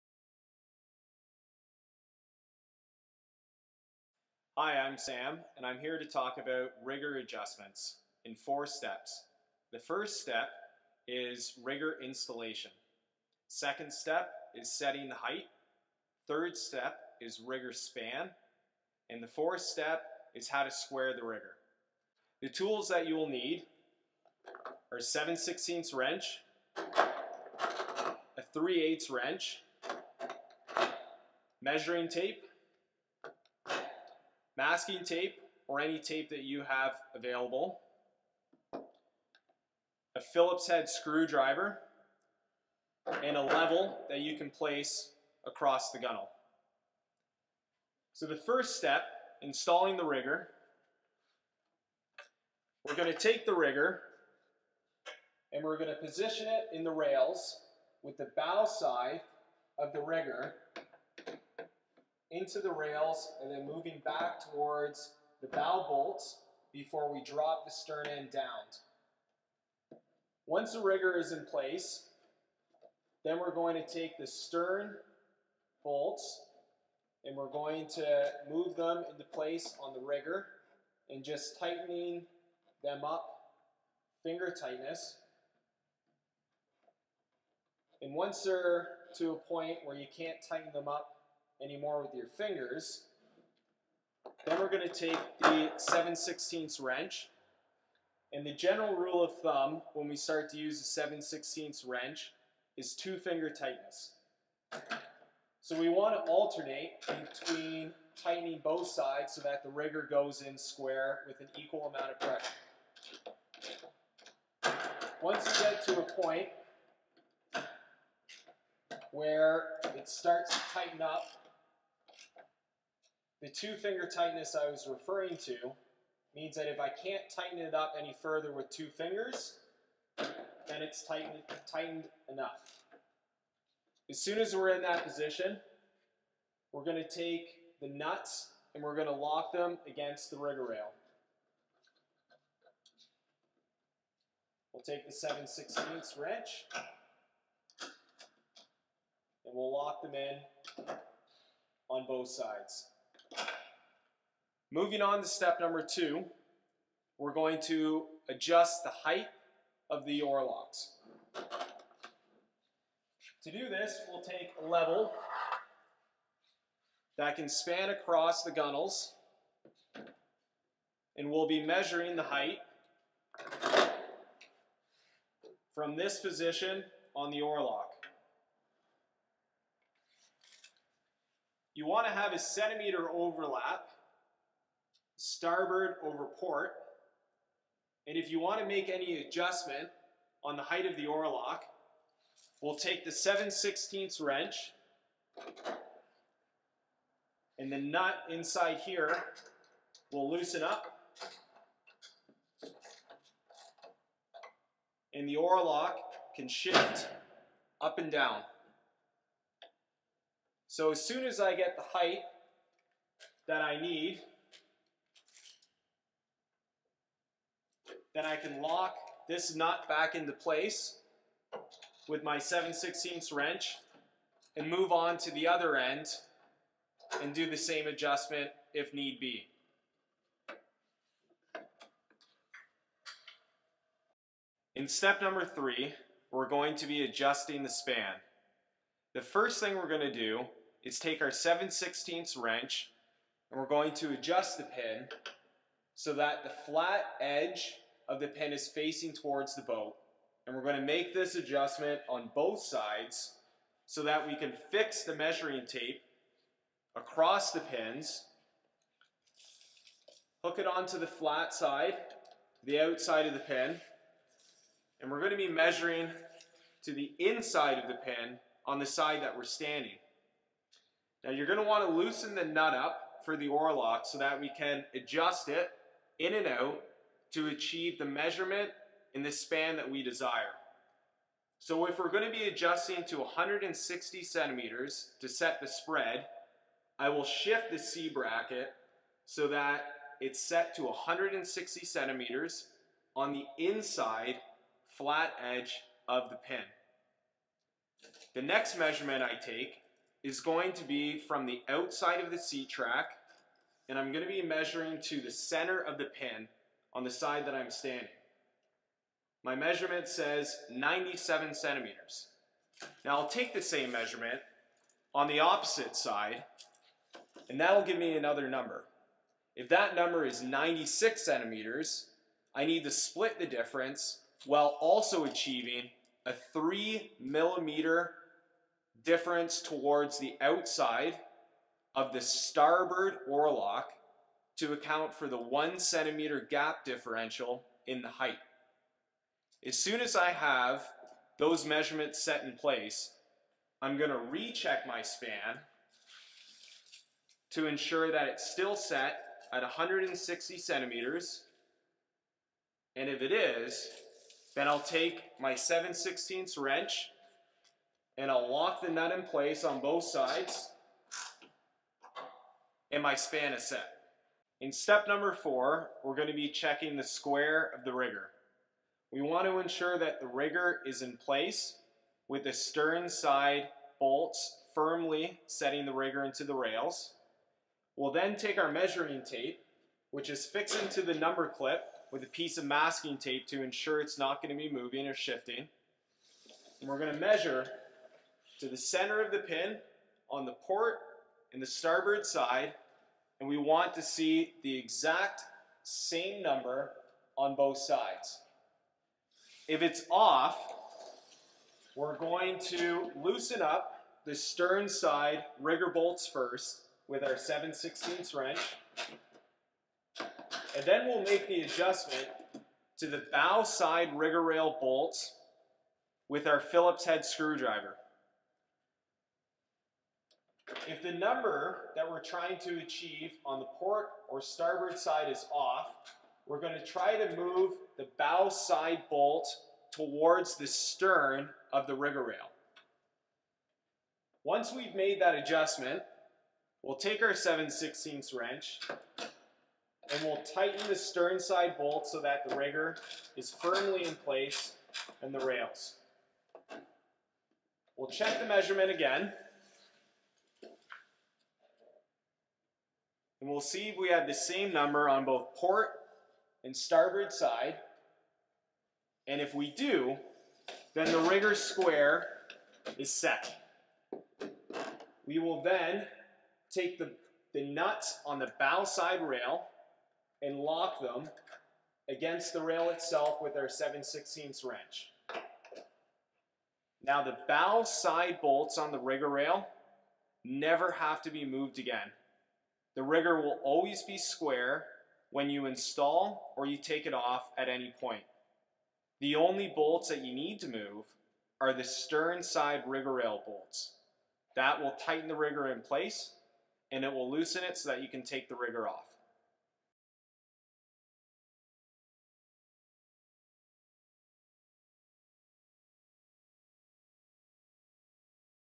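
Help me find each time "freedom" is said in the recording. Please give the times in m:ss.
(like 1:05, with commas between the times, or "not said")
not said.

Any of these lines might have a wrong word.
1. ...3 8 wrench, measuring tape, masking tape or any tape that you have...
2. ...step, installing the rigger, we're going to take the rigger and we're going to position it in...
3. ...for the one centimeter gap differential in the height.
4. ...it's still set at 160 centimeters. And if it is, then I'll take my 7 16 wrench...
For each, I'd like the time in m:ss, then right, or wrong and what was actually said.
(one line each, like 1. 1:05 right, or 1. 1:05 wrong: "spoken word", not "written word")
1. 0:28 right
2. 0:48 right
3. 5:35 right
4. 5:48 right.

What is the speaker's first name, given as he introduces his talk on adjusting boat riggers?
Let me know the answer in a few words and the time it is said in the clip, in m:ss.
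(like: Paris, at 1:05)
Sam, at 0:04.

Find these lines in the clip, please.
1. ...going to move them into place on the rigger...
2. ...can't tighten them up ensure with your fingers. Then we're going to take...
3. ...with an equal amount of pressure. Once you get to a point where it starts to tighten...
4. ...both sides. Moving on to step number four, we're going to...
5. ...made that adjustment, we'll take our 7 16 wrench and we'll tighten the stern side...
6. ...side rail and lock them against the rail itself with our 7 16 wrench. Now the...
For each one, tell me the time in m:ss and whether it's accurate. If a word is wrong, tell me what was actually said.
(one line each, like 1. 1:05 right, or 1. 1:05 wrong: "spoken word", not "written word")
1. 1:17 right
2. 1:30 wrong: "anymore", not "ensure"
3. 1:51 right
4. 2:32 wrong: "two", not "four"
5. 7:14 right
6. 7:48 right.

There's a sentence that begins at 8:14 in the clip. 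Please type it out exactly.
That will tighten the rigger in place and it will loosen it so that you can take the rigger off.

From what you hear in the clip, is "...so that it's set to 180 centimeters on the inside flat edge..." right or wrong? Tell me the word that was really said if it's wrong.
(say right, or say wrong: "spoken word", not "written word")
wrong: "160", not "180".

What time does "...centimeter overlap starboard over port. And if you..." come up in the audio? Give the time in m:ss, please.
3:02.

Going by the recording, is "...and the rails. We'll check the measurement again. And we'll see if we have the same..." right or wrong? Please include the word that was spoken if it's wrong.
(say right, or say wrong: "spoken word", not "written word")
right.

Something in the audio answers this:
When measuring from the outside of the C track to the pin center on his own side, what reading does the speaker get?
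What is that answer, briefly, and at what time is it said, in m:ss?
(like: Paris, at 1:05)
97 centimeters, at 5:10.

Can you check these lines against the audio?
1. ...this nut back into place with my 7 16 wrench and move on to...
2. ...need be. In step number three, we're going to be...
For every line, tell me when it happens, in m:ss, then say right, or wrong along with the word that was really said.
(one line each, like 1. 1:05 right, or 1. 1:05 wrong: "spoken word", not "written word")
1. 3:39 right
2. 3:48 right.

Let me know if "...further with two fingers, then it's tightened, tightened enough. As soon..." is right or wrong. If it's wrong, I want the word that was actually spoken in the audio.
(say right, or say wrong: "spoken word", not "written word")
right.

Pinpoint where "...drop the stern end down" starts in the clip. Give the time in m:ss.
1:07.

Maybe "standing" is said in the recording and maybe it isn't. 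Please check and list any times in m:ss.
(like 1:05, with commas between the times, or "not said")
4:29, 5:07.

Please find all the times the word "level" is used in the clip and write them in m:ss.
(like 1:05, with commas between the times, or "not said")
0:43, 2:44.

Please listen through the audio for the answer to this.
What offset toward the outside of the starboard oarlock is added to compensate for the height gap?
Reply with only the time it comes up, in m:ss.
5:26.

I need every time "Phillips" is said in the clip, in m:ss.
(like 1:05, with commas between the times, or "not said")
0:40, 6:56.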